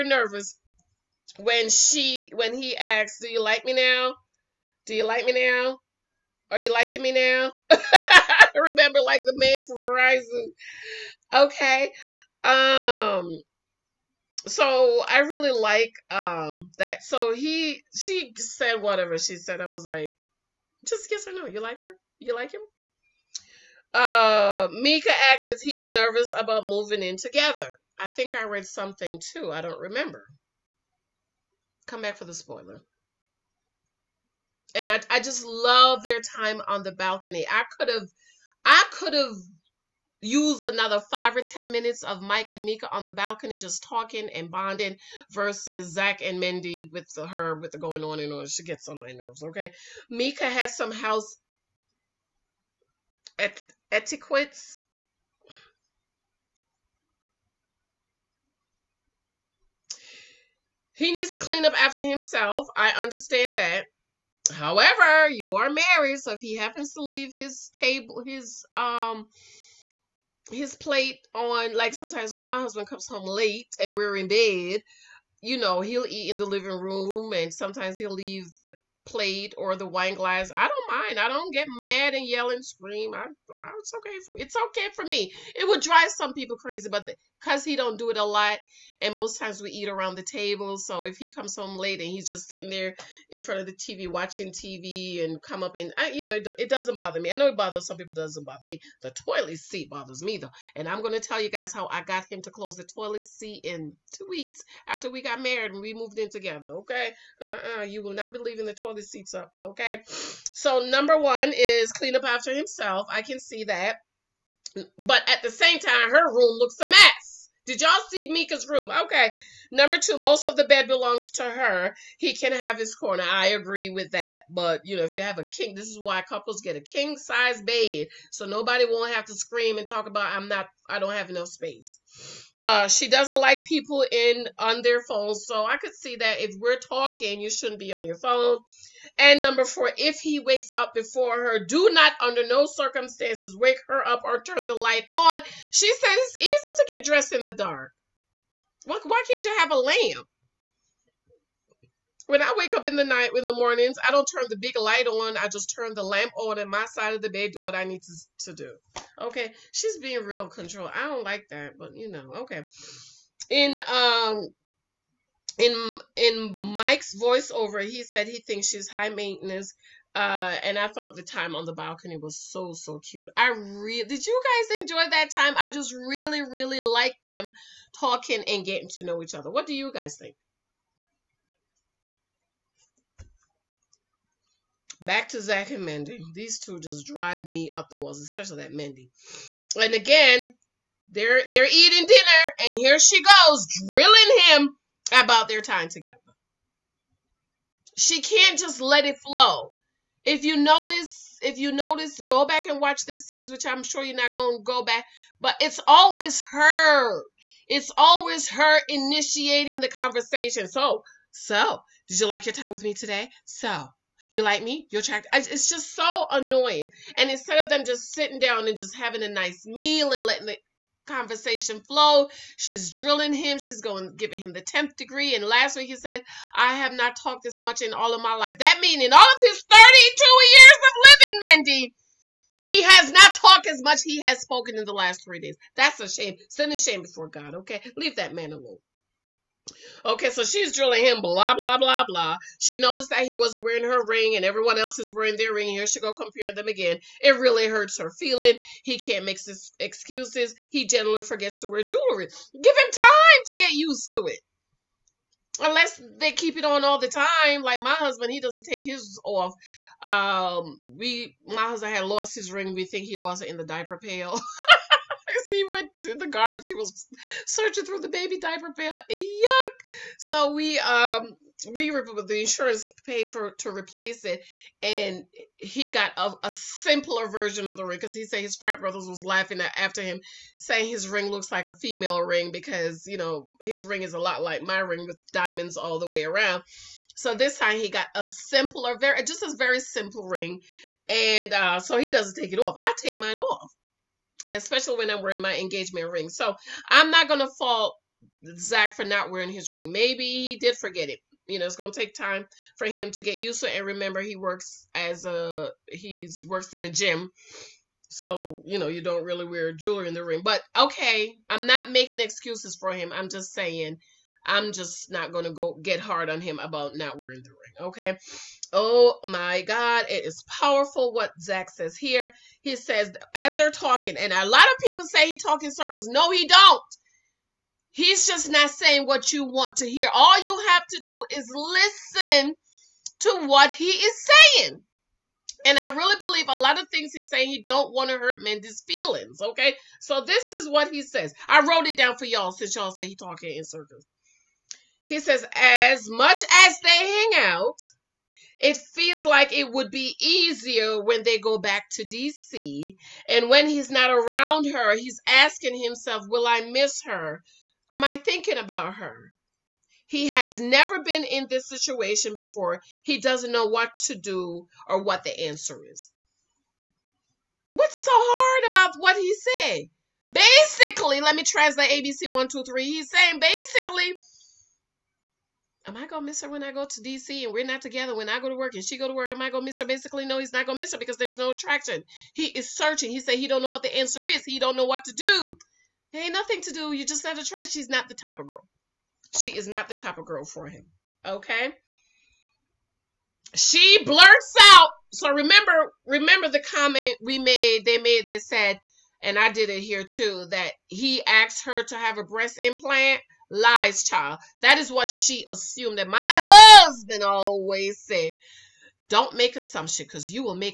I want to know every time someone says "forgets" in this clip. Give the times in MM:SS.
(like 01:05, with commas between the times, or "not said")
04:11, 05:00.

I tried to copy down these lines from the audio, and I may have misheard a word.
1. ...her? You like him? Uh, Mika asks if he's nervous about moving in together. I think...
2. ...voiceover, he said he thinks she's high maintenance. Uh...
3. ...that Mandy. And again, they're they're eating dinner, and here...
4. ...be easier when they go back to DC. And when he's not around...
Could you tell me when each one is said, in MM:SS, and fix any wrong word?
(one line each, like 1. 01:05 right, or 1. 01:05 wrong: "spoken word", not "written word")
1. 00:21 right
2. 02:47 right
3. 03:08 right
4. 05:49 right.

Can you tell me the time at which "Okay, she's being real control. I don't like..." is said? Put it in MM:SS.
02:39.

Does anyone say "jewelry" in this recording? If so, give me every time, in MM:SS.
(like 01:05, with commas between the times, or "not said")
04:11, 05:09.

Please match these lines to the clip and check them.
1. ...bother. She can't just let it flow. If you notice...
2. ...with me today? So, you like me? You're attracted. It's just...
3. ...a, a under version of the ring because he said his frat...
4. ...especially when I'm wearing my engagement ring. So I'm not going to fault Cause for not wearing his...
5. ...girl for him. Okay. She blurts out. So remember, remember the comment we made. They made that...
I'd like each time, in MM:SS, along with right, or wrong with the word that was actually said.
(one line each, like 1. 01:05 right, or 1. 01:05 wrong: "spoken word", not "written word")
1. 03:15 wrong: "together", not "bother"
2. 03:32 right
3. 04:36 wrong: "simpler", not "under"
4. 04:54 wrong: "Zach", not "Cause"
5. 06:30 right.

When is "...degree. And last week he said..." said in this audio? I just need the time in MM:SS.
03:44.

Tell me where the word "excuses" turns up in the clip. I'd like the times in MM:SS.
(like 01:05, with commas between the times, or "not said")
04:09, 05:12.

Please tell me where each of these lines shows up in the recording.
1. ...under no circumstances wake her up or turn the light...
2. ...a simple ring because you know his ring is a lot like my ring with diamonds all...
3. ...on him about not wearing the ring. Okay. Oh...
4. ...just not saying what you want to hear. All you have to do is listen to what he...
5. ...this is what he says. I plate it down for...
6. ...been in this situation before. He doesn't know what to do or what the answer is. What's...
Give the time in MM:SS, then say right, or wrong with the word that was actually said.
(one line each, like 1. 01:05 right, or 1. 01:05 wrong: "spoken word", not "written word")
1. 02:22 right
2. 04:41 wrong: "female", not "simple"
3. 05:16 right
4. 05:28 right
5. 05:40 wrong: "wrote", not "plate"
6. 06:01 right.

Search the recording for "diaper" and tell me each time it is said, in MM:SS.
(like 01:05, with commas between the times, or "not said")
04:23, 04:28.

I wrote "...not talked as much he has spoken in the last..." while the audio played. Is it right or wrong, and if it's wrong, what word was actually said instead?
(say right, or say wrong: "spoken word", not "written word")
right.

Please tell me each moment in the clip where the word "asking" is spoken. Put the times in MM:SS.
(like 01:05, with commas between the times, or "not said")
05:55.